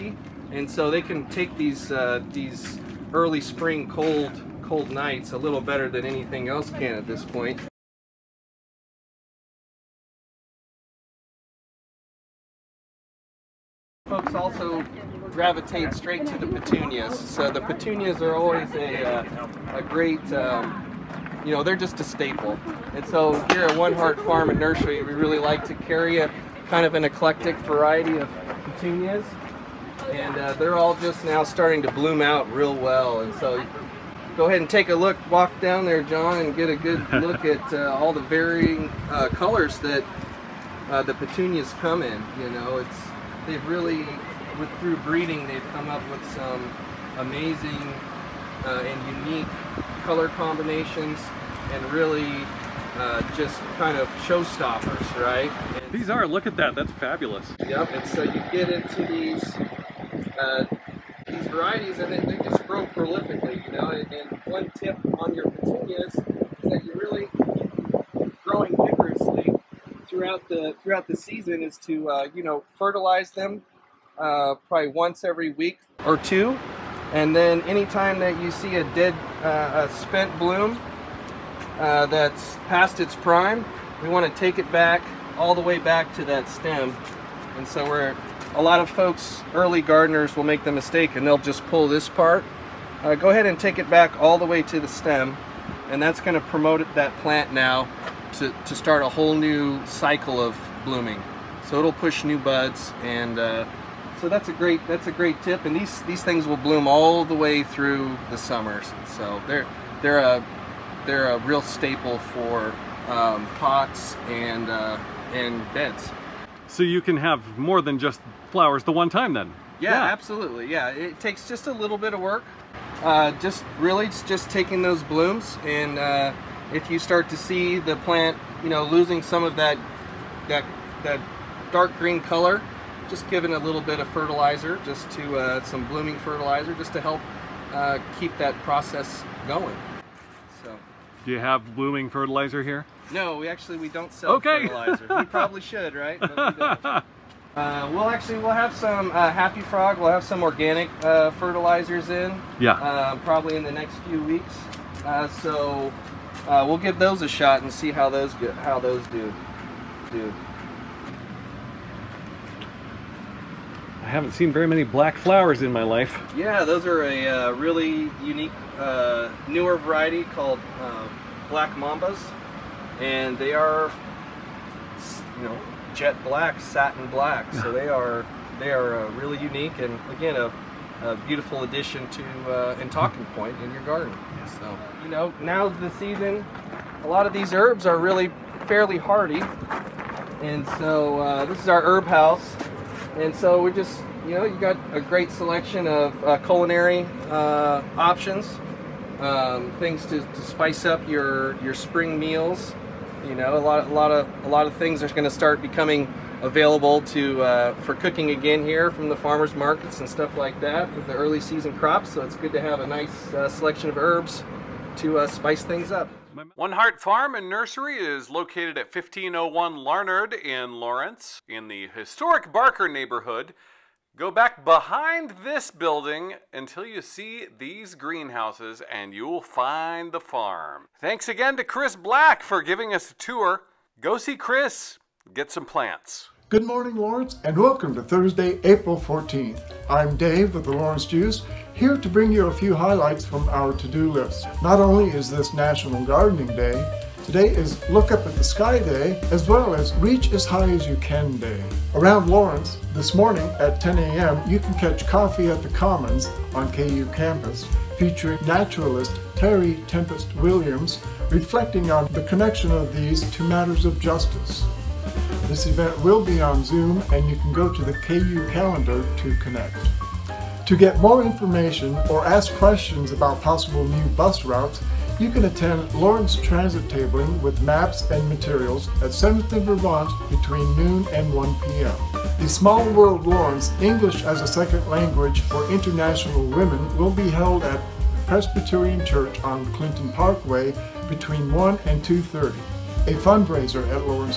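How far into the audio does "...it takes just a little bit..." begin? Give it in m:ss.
2:00.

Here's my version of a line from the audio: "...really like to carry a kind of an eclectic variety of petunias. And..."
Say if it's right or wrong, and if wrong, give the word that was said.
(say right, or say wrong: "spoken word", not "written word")
right.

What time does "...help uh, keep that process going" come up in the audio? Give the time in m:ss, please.
2:17.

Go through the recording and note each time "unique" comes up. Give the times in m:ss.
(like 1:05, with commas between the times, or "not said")
0:49, 2:48, 2:59.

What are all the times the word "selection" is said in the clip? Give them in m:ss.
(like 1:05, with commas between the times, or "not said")
3:15, 3:33.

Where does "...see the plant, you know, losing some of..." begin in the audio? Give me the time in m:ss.
2:07.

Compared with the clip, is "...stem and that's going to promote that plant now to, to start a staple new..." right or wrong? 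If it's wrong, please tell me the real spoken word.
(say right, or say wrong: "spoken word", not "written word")
wrong: "whole", not "staple".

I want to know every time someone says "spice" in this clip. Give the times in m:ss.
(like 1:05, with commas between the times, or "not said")
3:20, 3:35.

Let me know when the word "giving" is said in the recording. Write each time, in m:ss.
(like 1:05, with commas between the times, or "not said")
2:13, 3:52.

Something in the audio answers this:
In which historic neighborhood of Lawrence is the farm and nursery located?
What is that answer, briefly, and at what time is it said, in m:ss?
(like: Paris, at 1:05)
Barker, at 3:42.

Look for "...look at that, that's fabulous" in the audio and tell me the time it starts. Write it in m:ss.
0:56.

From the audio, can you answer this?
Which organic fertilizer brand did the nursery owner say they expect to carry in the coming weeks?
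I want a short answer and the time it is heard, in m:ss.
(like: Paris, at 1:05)
Happy Frog, at 2:29.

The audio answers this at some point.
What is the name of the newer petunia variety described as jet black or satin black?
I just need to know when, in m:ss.
2:51.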